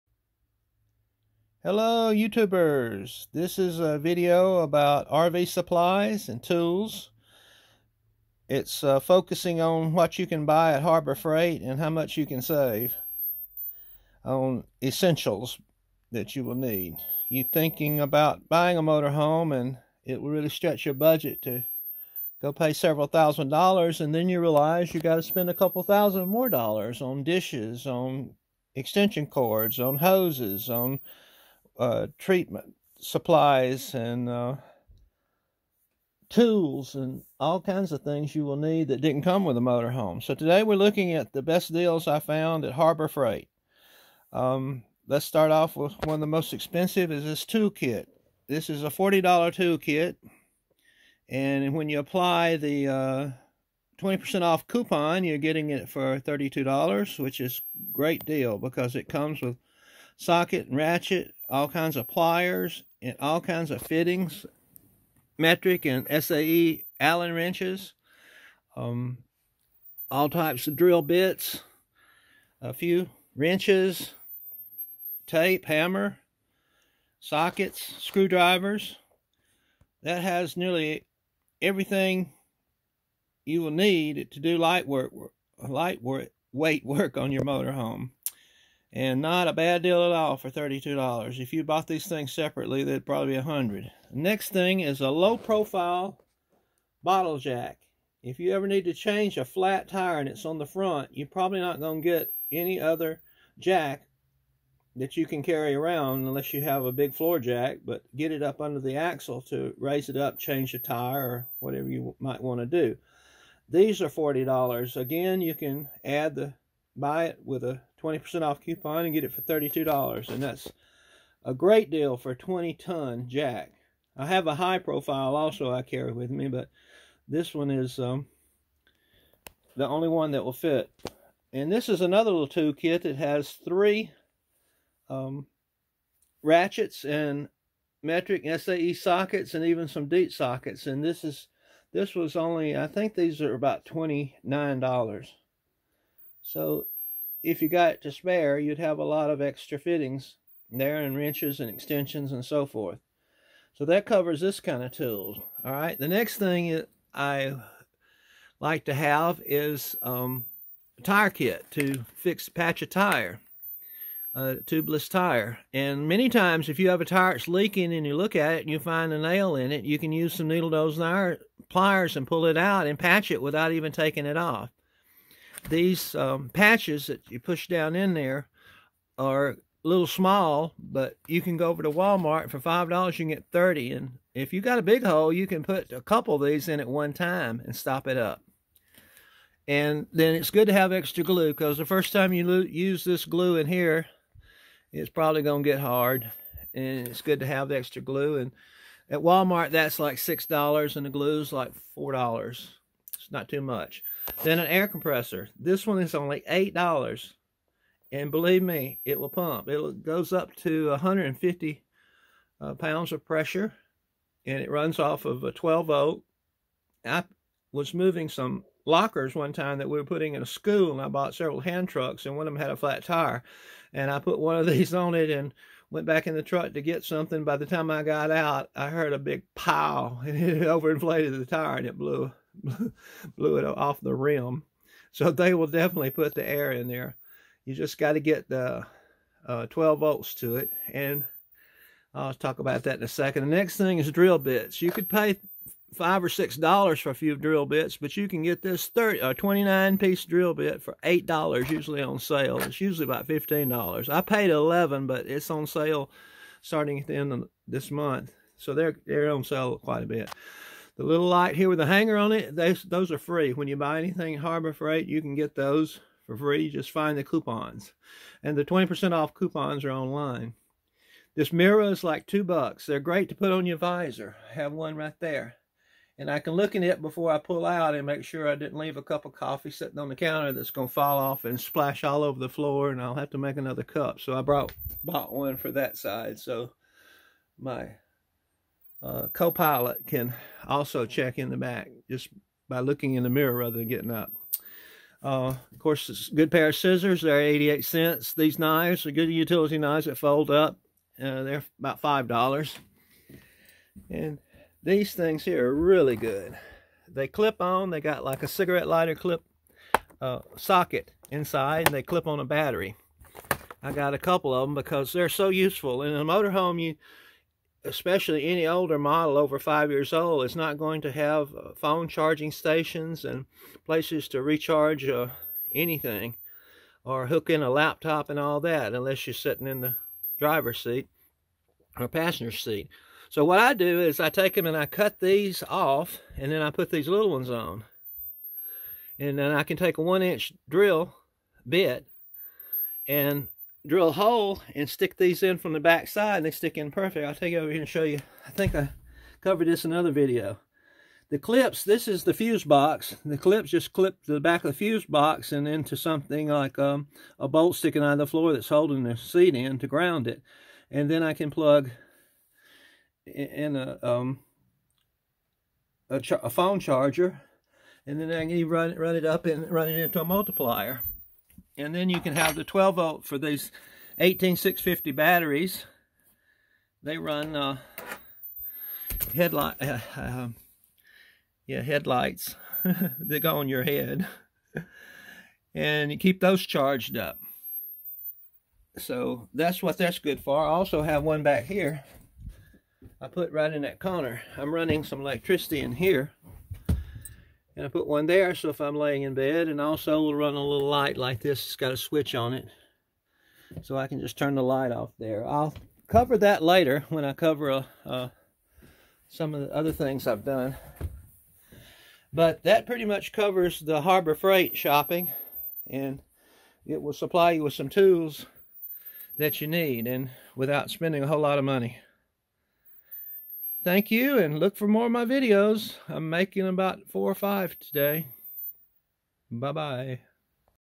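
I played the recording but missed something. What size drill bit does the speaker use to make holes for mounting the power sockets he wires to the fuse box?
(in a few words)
1 inch.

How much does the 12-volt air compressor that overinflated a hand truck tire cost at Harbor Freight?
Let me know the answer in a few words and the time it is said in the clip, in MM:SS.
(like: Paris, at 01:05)
$8, at 03:26.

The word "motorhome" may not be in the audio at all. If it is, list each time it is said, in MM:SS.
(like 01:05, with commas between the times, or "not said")
00:18, 00:39, 01:27, 05:16.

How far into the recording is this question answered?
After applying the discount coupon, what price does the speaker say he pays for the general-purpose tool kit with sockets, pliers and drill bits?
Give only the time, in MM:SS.
00:56.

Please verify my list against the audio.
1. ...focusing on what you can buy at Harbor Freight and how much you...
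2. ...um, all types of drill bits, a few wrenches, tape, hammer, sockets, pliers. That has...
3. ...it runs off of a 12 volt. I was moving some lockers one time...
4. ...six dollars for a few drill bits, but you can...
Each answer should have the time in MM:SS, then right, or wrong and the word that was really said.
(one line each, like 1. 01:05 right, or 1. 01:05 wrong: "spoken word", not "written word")
1. 00:08 right
2. 01:08 wrong: "screwdrivers", not "pliers"
3. 03:34 right
4. 04:06 right.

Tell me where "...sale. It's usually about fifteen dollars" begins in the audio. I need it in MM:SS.
04:12.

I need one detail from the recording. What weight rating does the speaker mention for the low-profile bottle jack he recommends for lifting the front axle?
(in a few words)
20 ton.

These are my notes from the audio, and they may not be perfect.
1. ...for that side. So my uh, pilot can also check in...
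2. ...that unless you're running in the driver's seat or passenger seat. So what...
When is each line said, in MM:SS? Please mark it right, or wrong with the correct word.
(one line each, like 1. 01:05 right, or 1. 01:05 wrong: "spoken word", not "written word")
1. 04:45 right
2. 05:28 wrong: "sitting", not "running".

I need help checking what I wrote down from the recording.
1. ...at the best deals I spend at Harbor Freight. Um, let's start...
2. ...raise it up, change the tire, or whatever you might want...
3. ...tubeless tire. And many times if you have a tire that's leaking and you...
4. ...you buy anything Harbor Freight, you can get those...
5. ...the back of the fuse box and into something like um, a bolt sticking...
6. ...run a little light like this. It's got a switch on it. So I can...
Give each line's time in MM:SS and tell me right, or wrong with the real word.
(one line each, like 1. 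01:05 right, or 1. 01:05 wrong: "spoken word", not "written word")
1. 00:41 wrong: "found", not "spend"
2. 01:49 right
3. 02:44 right
4. 04:23 right
5. 05:54 right
6. 06:40 right.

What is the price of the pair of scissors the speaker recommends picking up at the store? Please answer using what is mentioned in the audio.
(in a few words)
88 cents.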